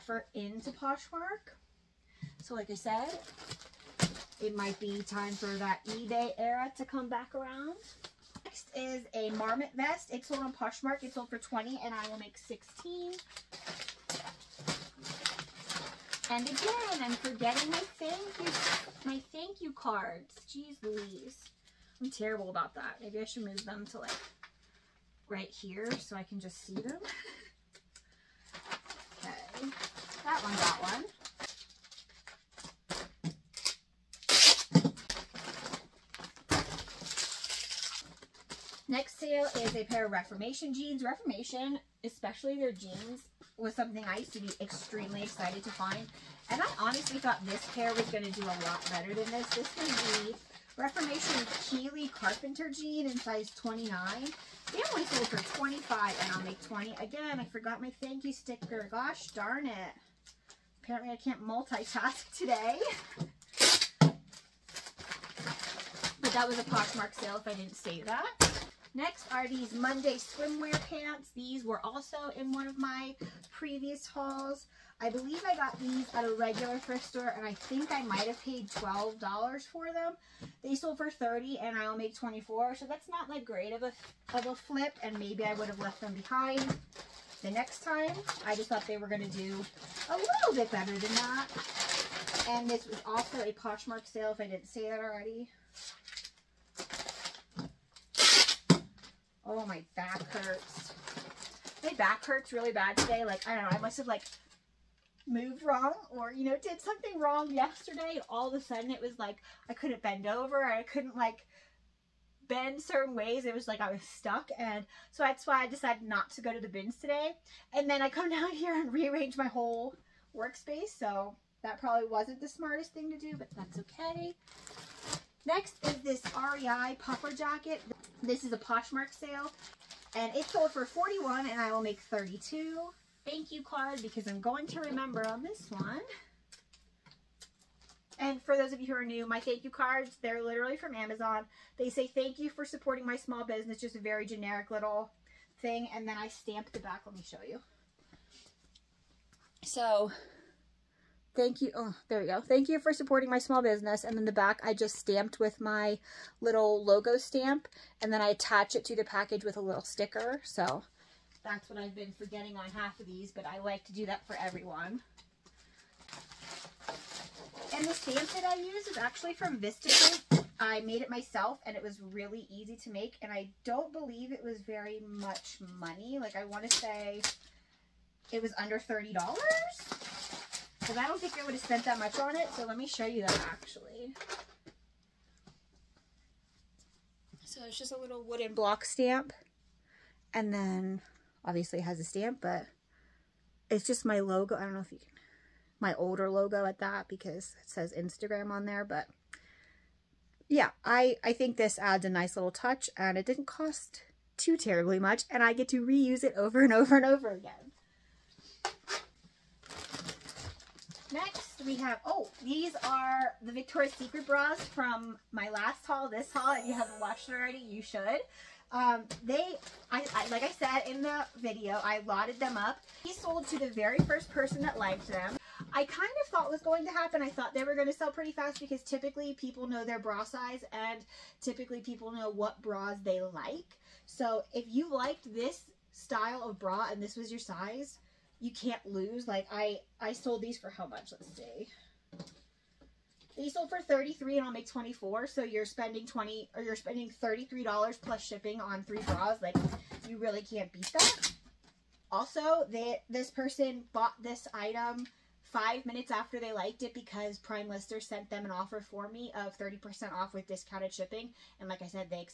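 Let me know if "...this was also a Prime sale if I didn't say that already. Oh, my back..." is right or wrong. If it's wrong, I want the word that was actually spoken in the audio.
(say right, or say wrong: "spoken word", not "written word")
wrong: "Poshmark", not "Prime".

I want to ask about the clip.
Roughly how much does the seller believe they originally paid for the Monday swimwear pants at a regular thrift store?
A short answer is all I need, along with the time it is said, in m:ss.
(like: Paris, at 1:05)
$12, at 1:18.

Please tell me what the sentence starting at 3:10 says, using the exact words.
And then obviously it has a stamp, but it's just my logo.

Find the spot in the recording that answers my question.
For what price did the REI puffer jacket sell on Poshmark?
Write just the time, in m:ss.
2:10.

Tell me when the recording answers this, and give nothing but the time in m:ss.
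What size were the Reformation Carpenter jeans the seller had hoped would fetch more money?
0:53.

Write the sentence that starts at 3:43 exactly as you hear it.
He sold to the very first person that liked them.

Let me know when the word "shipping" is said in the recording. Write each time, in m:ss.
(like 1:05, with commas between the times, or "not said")
4:08, 4:20.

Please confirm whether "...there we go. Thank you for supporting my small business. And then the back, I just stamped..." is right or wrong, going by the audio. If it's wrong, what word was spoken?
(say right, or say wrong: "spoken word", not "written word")
right.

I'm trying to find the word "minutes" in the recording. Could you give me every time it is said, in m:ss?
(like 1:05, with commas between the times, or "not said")
4:15.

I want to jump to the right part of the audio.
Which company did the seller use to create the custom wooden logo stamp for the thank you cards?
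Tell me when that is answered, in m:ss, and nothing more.
2:49.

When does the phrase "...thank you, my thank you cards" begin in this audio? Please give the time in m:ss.
0:17.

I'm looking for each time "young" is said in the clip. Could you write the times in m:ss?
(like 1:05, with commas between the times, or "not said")
not said.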